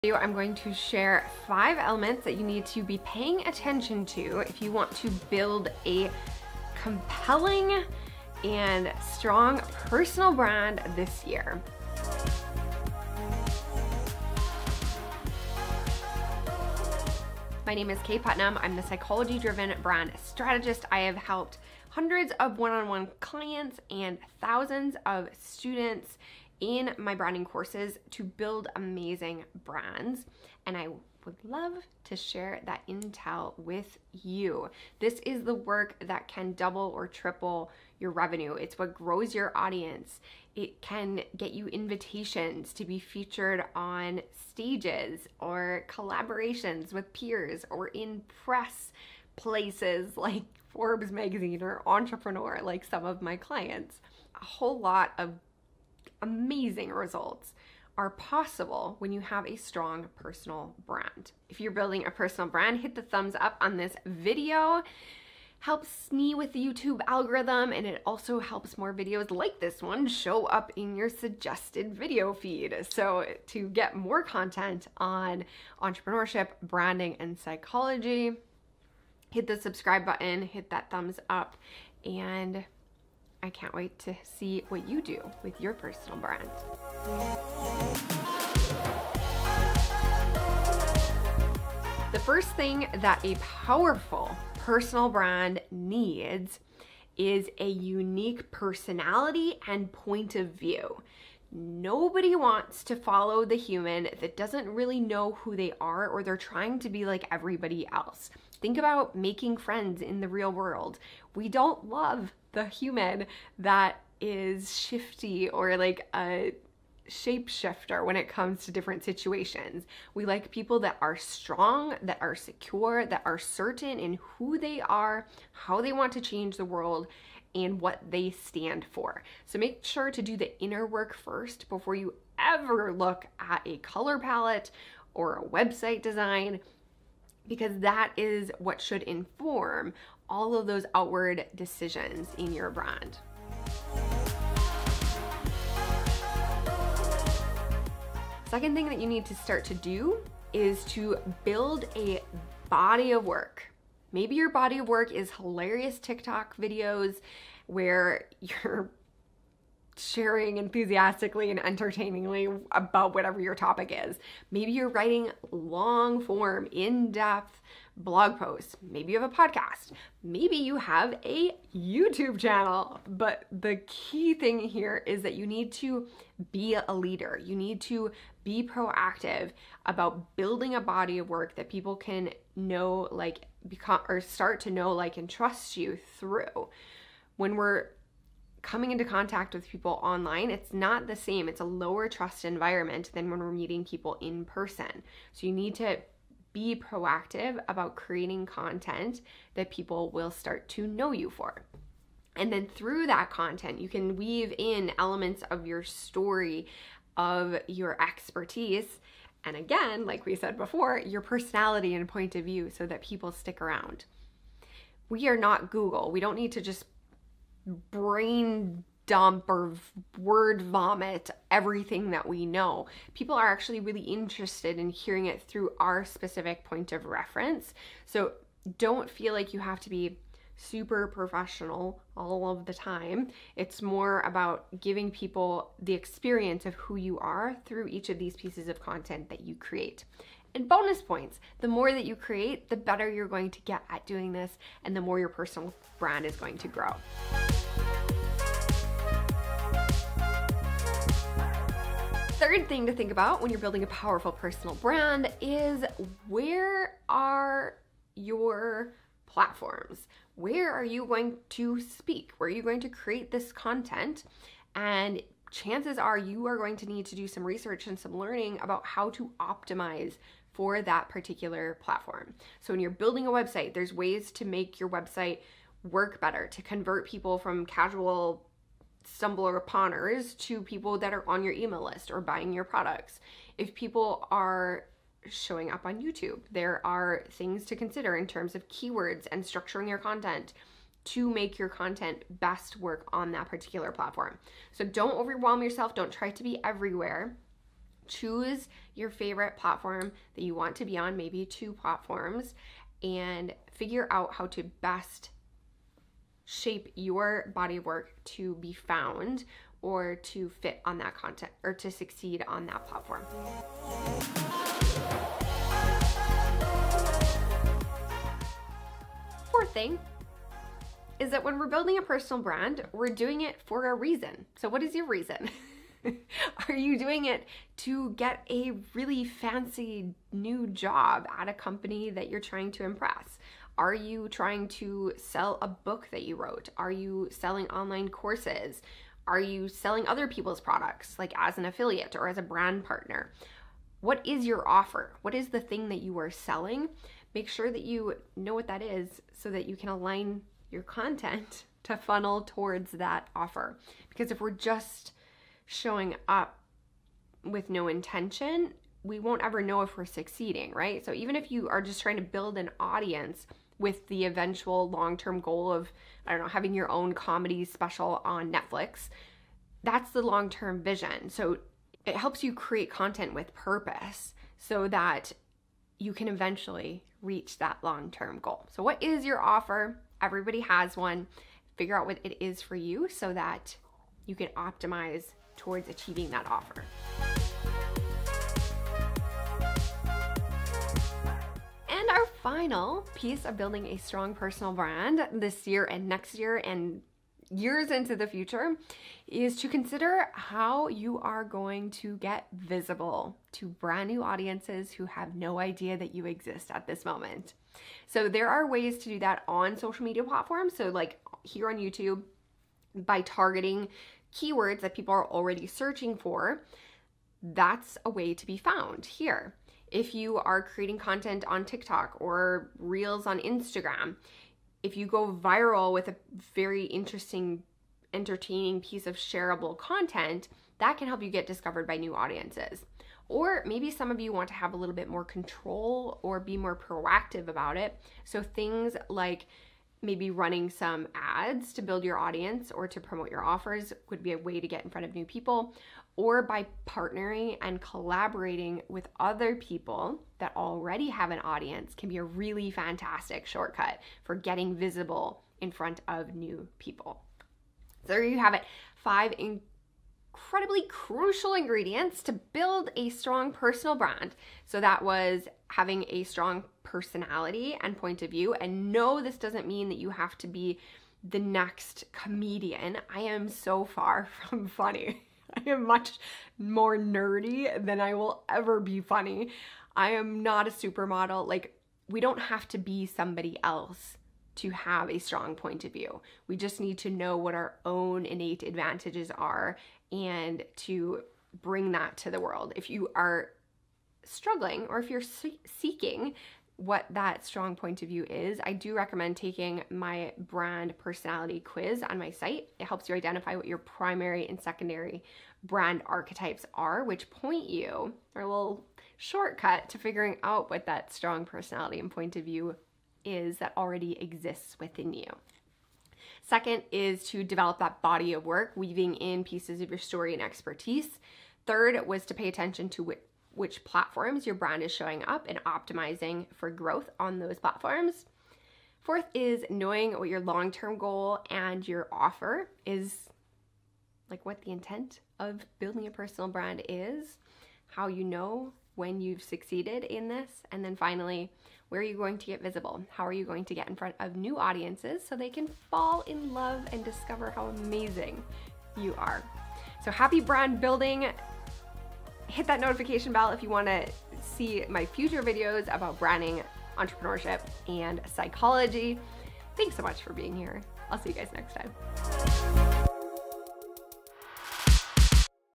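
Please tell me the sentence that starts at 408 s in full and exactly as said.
So there are ways to do that on social media platforms.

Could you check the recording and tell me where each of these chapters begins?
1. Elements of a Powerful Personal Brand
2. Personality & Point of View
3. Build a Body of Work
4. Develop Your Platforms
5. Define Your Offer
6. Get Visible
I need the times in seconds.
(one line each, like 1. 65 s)
1. 16 s
2. 91 s
3. 147 s
4. 251 s
5. 318 s
6. 391 s.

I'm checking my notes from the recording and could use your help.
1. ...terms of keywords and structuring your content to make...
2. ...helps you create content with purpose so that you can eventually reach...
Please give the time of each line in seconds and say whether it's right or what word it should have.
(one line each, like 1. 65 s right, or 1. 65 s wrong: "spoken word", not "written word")
1. 288 s right
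2. 372 s right.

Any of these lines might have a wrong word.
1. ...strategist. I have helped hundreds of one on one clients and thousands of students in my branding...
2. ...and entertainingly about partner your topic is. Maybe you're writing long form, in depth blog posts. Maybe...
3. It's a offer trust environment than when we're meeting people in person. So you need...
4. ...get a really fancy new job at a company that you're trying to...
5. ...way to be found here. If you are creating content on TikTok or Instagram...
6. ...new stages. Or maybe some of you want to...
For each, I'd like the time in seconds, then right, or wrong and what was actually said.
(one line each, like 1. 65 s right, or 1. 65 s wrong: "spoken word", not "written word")
1. 20 s right
2. 161 s wrong: "whatever", not "partner"
3. 191 s wrong: "lower", not "offer"
4. 328 s right
5. 418 s wrong: "Reels", not "Instagram"
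6. 431 s wrong: "audiences", not "stages".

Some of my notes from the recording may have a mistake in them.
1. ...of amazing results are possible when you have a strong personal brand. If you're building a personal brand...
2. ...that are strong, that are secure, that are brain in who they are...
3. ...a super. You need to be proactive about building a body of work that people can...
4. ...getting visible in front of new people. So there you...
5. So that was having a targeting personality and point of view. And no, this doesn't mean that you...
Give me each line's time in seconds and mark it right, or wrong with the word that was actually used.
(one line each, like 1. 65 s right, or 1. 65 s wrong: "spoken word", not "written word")
1. 55 s right
2. 120 s wrong: "certain", not "brain"
3. 176 s wrong: "leader", not "super"
4. 454 s right
5. 464 s wrong: "strong", not "targeting".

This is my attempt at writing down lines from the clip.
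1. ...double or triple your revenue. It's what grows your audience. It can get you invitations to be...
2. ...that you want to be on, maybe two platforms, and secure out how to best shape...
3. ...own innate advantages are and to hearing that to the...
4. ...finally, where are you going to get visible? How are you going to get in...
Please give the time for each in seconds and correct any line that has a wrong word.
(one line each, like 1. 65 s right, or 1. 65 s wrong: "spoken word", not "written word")
1. 36 s right
2. 300 s wrong: "figure", not "secure"
3. 487 s wrong: "bring", not "hearing"
4. 540 s right.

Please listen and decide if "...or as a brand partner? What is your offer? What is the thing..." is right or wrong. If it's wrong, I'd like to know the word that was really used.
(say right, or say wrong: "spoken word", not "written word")
right.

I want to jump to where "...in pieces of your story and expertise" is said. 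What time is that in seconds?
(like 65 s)
519 s.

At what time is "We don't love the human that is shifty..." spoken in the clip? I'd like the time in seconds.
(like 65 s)
111 s.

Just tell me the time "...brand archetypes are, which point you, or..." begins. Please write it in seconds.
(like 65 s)
505 s.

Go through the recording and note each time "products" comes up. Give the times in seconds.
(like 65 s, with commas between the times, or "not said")
282 s, 340 s.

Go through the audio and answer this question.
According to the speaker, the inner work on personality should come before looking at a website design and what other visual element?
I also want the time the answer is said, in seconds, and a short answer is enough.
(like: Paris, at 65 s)
color palette, at 133 s.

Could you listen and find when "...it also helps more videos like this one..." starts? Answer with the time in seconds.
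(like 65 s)
67 s.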